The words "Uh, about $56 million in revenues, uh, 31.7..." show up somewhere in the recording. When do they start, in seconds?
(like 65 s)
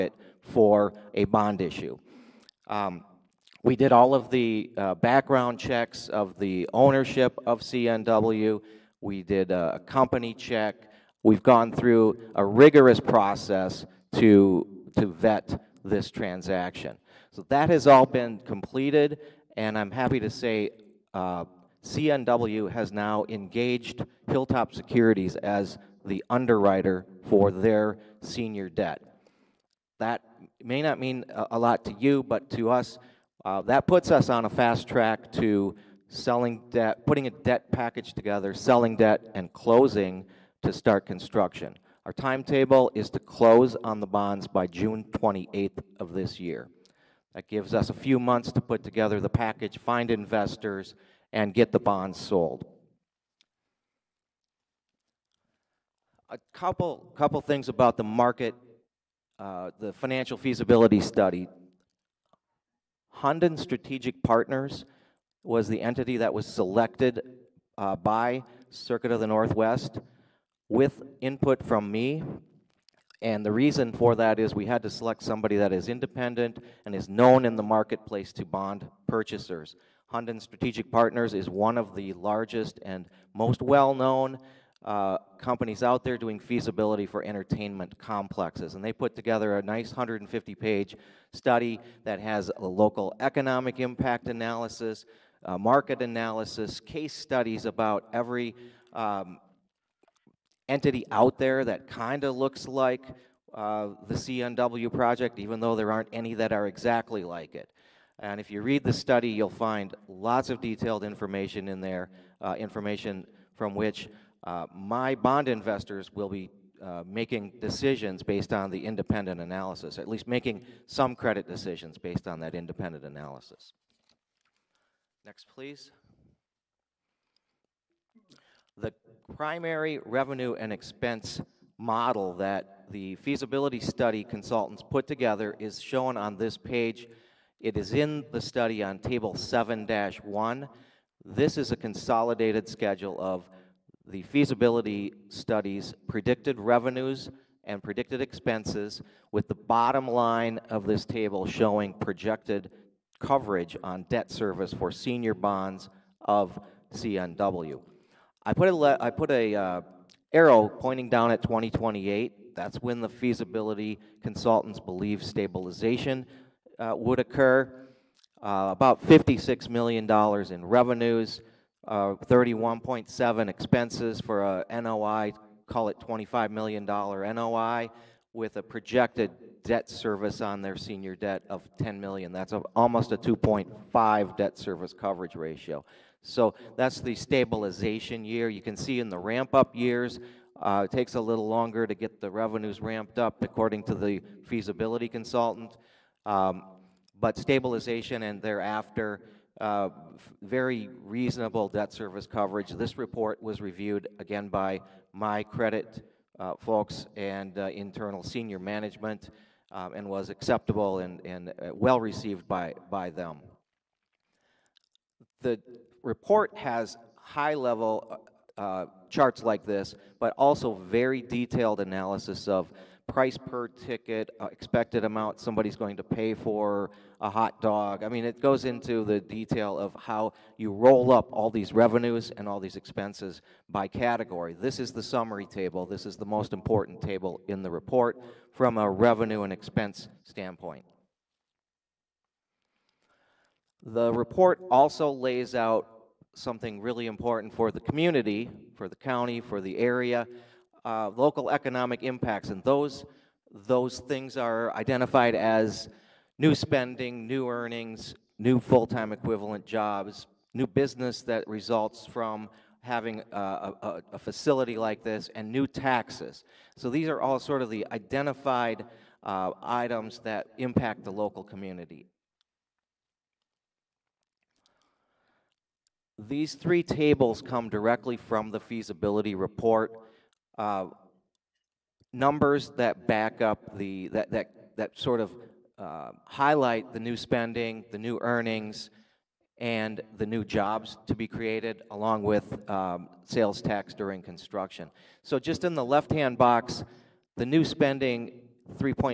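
168 s.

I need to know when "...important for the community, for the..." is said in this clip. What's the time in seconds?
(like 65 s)
247 s.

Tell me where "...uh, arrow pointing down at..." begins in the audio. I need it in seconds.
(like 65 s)
159 s.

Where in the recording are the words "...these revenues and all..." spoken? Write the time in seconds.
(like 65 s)
231 s.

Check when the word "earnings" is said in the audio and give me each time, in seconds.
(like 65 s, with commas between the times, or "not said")
257 s, 288 s.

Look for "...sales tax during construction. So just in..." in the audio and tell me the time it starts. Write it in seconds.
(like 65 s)
293 s.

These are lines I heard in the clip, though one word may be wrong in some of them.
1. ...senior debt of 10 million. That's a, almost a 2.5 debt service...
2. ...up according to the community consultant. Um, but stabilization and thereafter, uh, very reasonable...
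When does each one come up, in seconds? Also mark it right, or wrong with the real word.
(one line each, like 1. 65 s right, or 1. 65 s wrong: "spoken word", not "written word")
1. 180 s right
2. 193 s wrong: "feasibility", not "community".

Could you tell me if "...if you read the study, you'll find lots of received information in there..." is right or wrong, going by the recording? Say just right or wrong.
wrong.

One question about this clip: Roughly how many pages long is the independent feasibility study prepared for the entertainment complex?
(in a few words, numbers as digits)
150.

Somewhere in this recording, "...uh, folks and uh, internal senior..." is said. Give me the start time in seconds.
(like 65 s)
206 s.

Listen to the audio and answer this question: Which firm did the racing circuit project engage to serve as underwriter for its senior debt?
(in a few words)
Hilltop Securities.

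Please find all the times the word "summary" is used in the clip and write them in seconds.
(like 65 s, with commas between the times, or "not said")
235 s.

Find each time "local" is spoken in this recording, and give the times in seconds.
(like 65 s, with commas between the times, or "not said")
92 s, 251 s, 271 s.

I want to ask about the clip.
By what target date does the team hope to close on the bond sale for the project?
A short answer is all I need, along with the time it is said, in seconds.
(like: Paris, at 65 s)
June 28, at 44 s.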